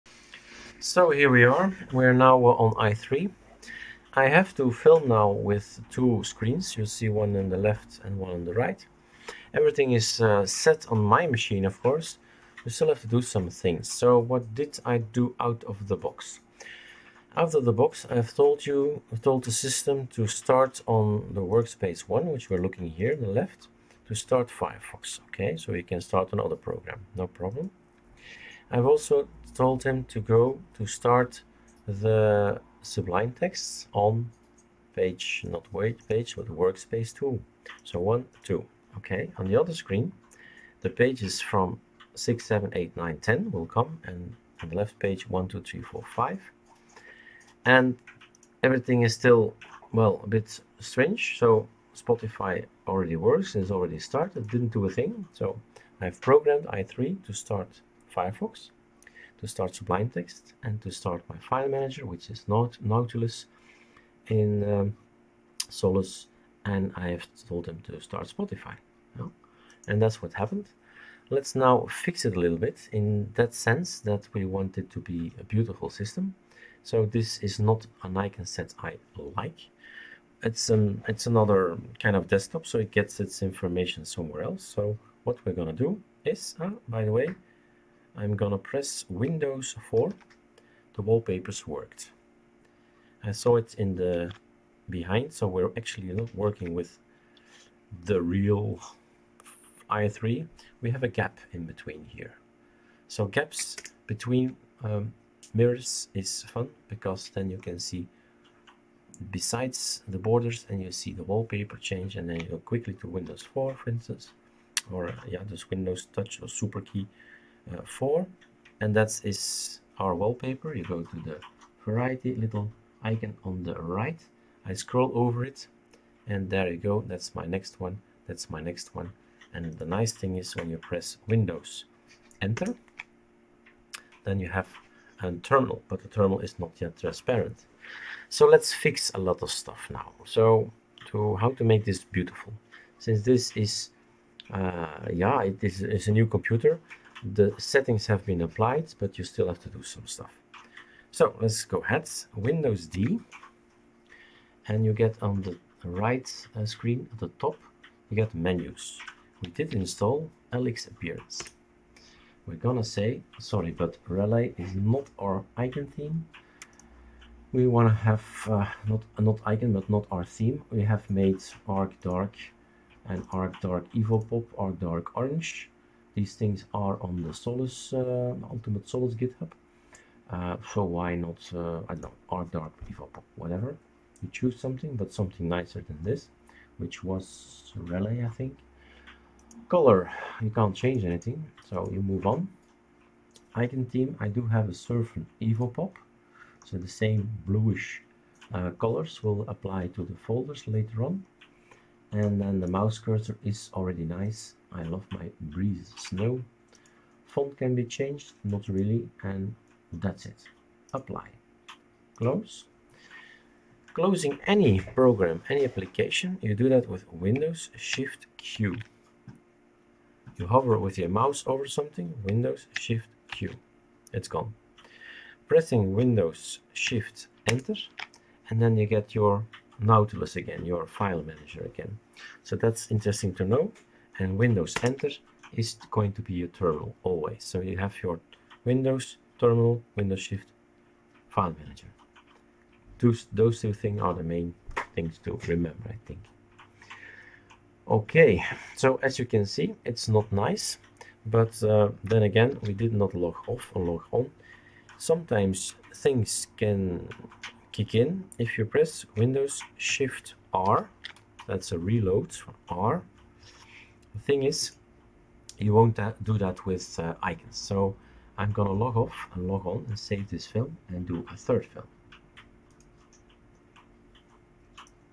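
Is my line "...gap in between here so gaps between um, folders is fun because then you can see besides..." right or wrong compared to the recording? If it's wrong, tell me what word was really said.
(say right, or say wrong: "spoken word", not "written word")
wrong: "mirrors", not "folders".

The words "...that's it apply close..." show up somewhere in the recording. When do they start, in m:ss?
3:29.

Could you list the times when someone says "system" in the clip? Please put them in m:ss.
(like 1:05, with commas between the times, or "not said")
0:19, 1:15.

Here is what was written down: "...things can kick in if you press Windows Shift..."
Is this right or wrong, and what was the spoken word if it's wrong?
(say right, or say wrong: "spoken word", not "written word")
right.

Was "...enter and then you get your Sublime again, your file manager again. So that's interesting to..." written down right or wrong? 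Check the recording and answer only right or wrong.
wrong.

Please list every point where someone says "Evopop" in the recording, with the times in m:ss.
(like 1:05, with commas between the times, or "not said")
2:53, 3:02, 3:15.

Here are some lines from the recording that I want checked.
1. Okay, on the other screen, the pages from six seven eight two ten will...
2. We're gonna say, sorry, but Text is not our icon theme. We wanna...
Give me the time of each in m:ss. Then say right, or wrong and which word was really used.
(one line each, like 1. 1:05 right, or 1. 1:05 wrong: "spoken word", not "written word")
1. 0:38 wrong: "nine", not "two"
2. 2:42 wrong: "Relay", not "Text".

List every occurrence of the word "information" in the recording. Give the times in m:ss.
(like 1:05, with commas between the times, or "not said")
1:23.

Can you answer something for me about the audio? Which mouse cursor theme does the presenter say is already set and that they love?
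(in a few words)
Breeze Snow.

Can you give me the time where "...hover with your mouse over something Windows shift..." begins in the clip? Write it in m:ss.
3:40.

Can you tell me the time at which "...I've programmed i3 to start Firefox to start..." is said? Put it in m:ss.
0:55.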